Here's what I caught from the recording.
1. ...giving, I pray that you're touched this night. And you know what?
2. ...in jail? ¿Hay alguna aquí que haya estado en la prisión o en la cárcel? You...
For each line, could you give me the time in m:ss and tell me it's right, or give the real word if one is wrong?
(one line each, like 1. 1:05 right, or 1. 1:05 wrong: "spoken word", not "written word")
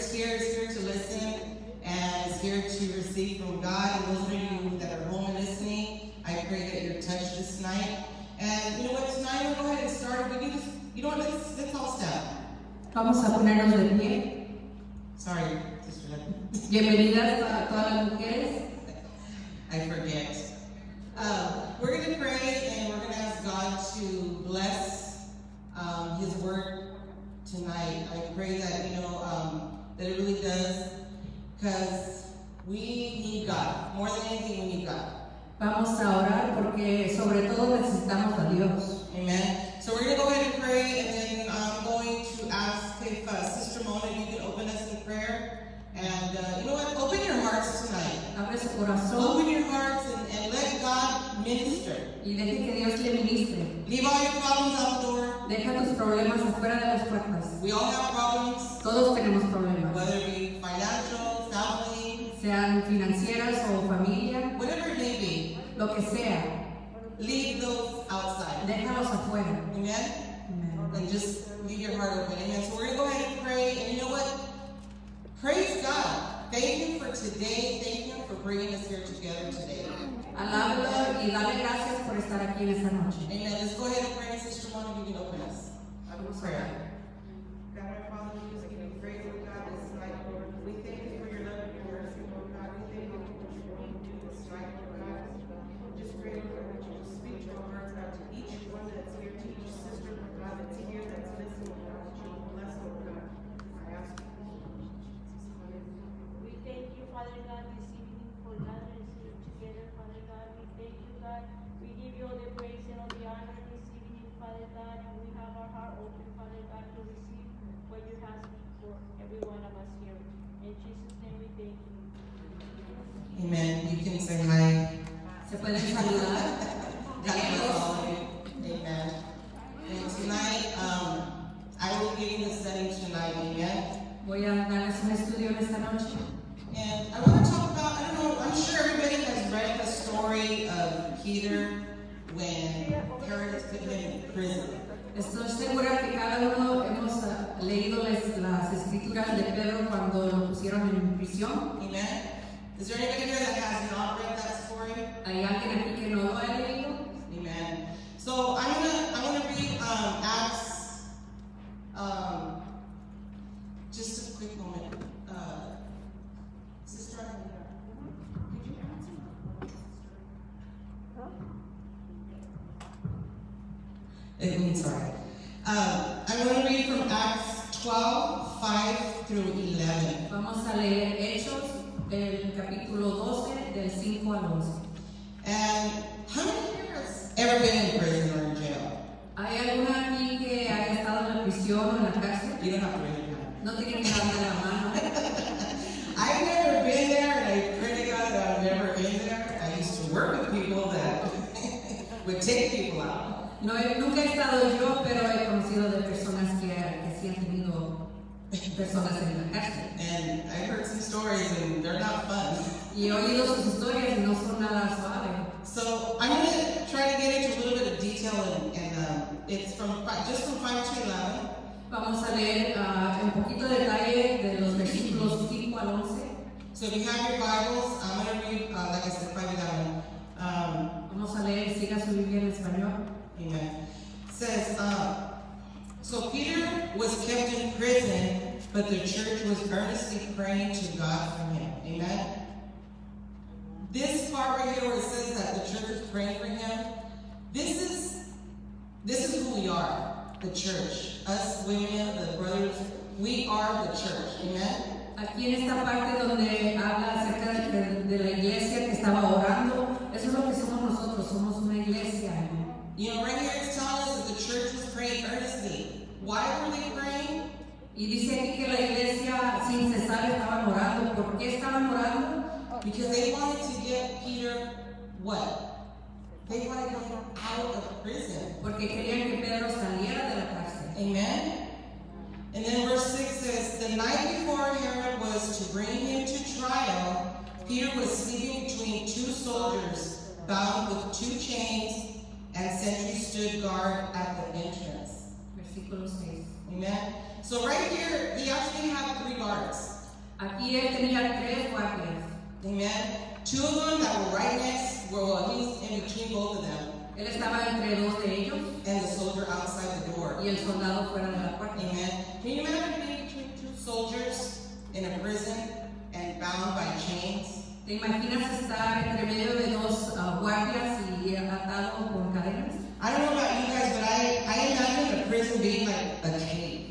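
1. 0:05 wrong: "listening", not "giving"
2. 3:08 right.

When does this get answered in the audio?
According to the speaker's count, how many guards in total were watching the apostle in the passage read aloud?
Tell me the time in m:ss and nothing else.
4:59.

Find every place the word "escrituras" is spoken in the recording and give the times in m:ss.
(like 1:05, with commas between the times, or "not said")
2:28.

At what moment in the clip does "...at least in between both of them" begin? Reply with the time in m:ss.
5:05.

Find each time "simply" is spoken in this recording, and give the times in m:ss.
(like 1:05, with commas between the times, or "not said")
not said.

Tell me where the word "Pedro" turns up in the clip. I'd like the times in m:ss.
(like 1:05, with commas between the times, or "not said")
2:29, 4:39.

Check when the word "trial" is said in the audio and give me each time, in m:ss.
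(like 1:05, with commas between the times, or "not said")
4:46.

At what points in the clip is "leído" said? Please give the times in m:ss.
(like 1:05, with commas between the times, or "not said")
2:27, 2:36.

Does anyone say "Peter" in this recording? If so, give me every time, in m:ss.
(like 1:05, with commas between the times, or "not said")
2:21, 3:56, 4:34, 4:47.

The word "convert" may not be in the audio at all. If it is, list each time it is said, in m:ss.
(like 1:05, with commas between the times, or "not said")
not said.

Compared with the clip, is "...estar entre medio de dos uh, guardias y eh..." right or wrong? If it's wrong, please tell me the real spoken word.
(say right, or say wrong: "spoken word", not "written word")
right.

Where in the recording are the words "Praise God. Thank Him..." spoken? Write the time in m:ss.
1:15.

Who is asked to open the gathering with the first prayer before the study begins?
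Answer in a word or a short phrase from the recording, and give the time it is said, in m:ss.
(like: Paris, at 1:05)
Sister Mona, at 1:24.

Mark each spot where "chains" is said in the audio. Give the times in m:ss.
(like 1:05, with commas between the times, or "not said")
4:51, 5:16.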